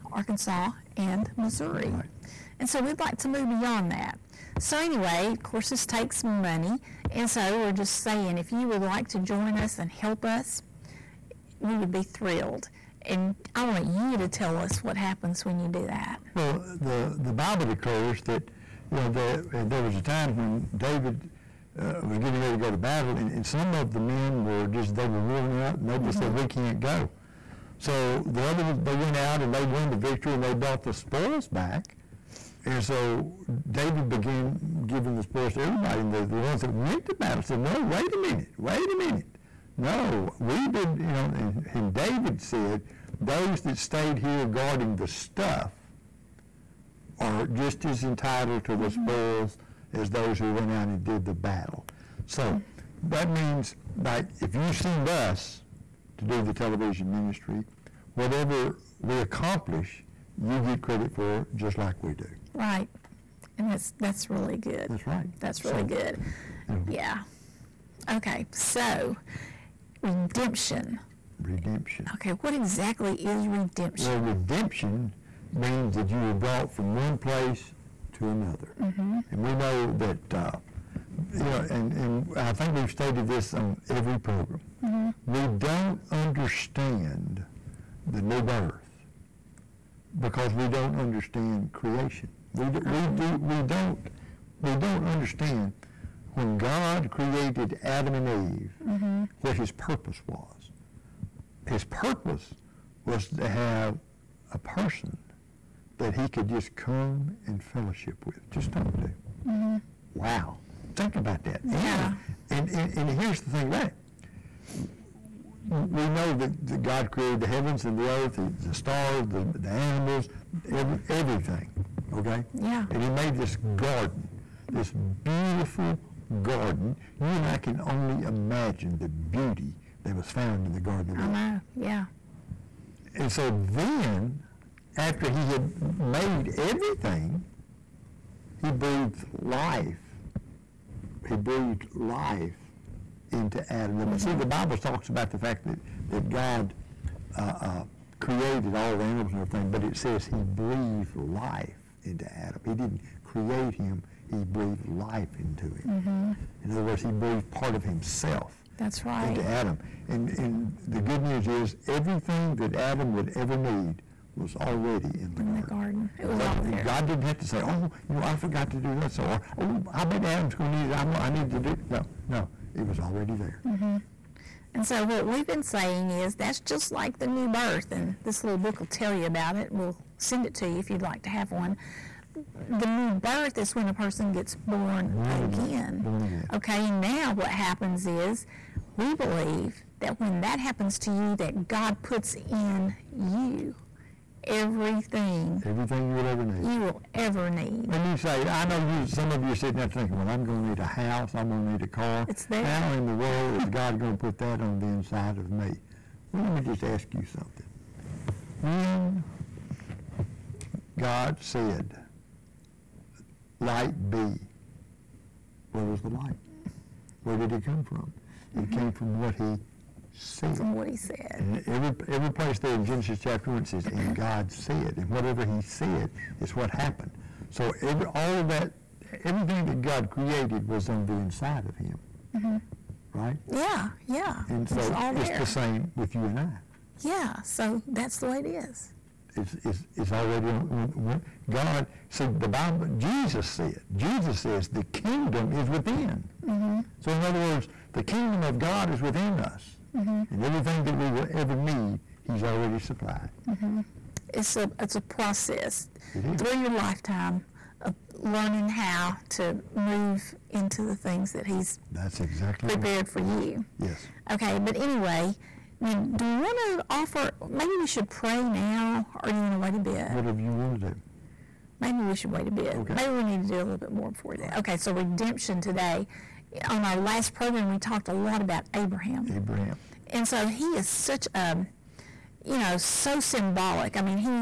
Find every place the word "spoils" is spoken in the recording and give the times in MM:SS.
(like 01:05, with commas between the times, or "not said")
00:30, 00:35, 00:49.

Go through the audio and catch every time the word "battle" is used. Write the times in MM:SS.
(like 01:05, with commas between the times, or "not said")
00:22, 00:37, 00:51.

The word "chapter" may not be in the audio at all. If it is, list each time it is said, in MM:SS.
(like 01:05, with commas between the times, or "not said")
03:43.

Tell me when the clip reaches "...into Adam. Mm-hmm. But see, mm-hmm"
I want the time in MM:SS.
02:23.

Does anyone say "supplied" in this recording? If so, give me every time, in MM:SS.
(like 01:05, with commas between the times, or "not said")
04:12.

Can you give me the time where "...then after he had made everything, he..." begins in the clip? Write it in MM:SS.
02:13.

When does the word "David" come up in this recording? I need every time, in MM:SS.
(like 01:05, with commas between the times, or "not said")
00:20, 00:33, 00:41.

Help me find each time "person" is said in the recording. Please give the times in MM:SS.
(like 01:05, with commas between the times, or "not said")
01:44, 03:03.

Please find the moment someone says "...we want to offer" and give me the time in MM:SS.
04:26.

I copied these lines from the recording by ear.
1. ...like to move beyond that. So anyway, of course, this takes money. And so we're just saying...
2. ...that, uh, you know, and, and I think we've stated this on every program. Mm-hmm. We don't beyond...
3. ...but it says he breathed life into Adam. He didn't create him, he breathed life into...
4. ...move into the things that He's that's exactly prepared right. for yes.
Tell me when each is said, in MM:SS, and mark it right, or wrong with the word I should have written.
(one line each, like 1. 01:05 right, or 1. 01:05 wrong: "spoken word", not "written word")
1. 00:03 right
2. 01:19 wrong: "understand", not "beyond"
3. 02:29 right
4. 04:19 right.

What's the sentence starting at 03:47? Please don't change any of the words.
So every, all of that, everything that God created was on the inside of him.